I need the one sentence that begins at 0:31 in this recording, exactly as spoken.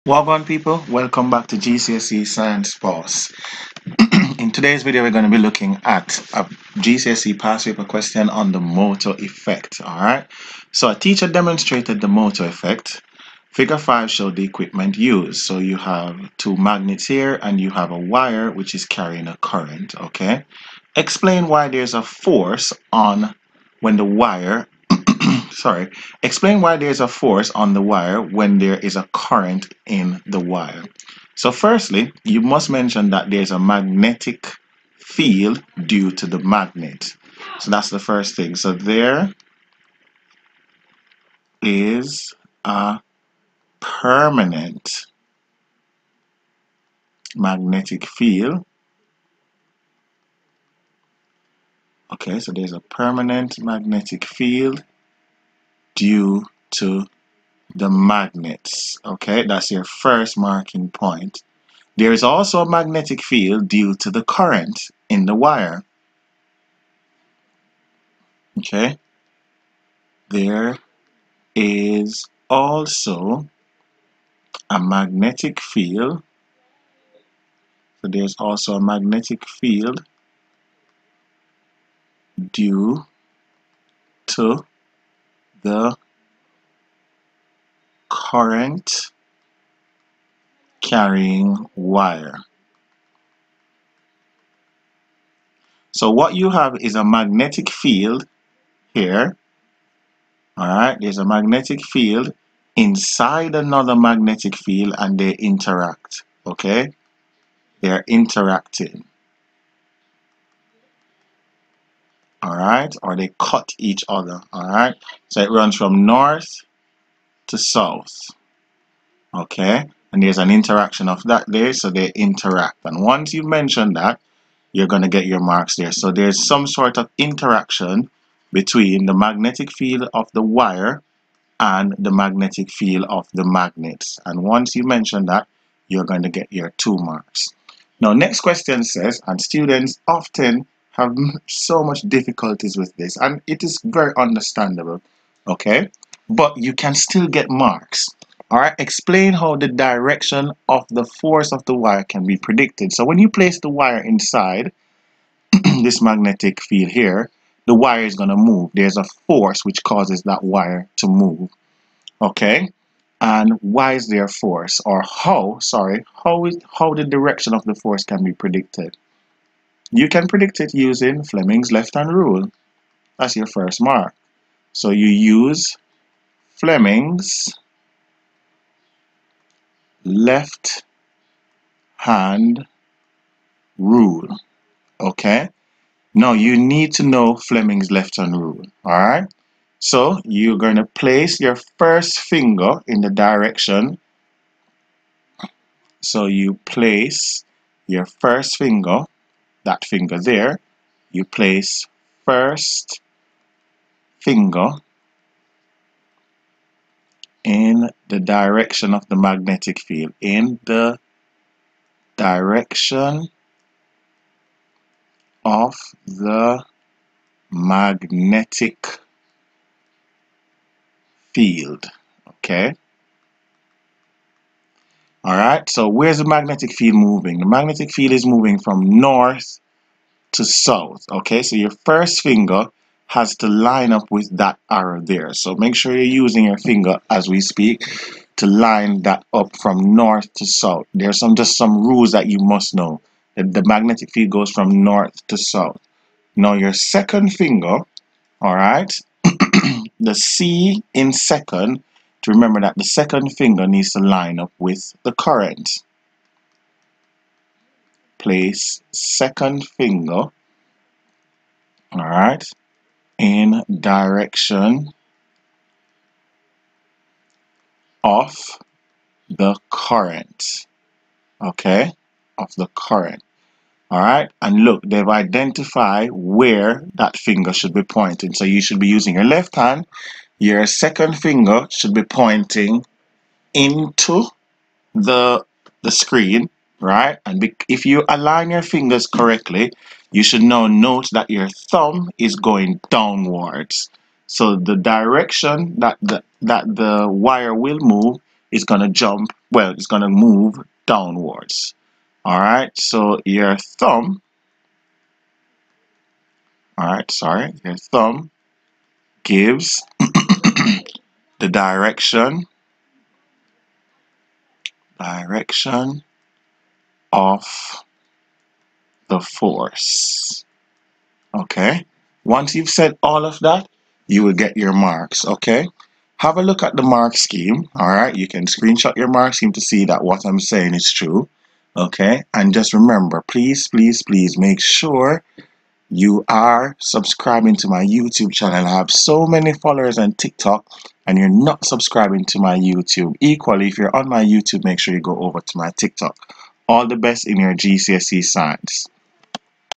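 So firstly, you must mention that there's a magnetic field due to the magnet.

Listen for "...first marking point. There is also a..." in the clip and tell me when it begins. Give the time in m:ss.
0:59.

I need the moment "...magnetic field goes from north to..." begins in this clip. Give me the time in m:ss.
4:03.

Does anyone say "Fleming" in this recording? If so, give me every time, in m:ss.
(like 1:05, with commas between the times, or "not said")
2:51, 2:56, 3:07.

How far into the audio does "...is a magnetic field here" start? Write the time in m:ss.
1:36.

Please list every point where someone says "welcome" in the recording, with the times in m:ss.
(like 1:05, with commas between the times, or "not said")
0:00.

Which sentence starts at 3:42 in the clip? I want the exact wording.
Okay, Alright, so where's the magnetic field moving?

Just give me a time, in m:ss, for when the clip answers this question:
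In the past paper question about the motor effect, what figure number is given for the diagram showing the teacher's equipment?
0:13.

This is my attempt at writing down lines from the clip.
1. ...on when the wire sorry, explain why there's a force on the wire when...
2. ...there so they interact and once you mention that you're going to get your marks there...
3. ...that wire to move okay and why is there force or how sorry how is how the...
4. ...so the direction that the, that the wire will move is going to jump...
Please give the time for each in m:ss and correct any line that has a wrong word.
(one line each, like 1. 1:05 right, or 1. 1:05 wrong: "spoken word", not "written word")
1. 0:22 right
2. 2:01 right
3. 2:40 right
4. 4:54 right.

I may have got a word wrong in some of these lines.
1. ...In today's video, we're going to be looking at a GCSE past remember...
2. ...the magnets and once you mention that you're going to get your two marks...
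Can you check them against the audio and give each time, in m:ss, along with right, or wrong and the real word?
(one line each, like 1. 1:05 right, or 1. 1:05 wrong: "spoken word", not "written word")
1. 0:04 wrong: "paper", not "remember"
2. 2:13 right.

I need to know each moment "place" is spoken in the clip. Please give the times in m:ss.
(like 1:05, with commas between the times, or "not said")
2:33, 3:10, 3:16, 3:21, 4:18.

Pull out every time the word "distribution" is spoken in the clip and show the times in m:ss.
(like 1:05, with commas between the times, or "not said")
not said.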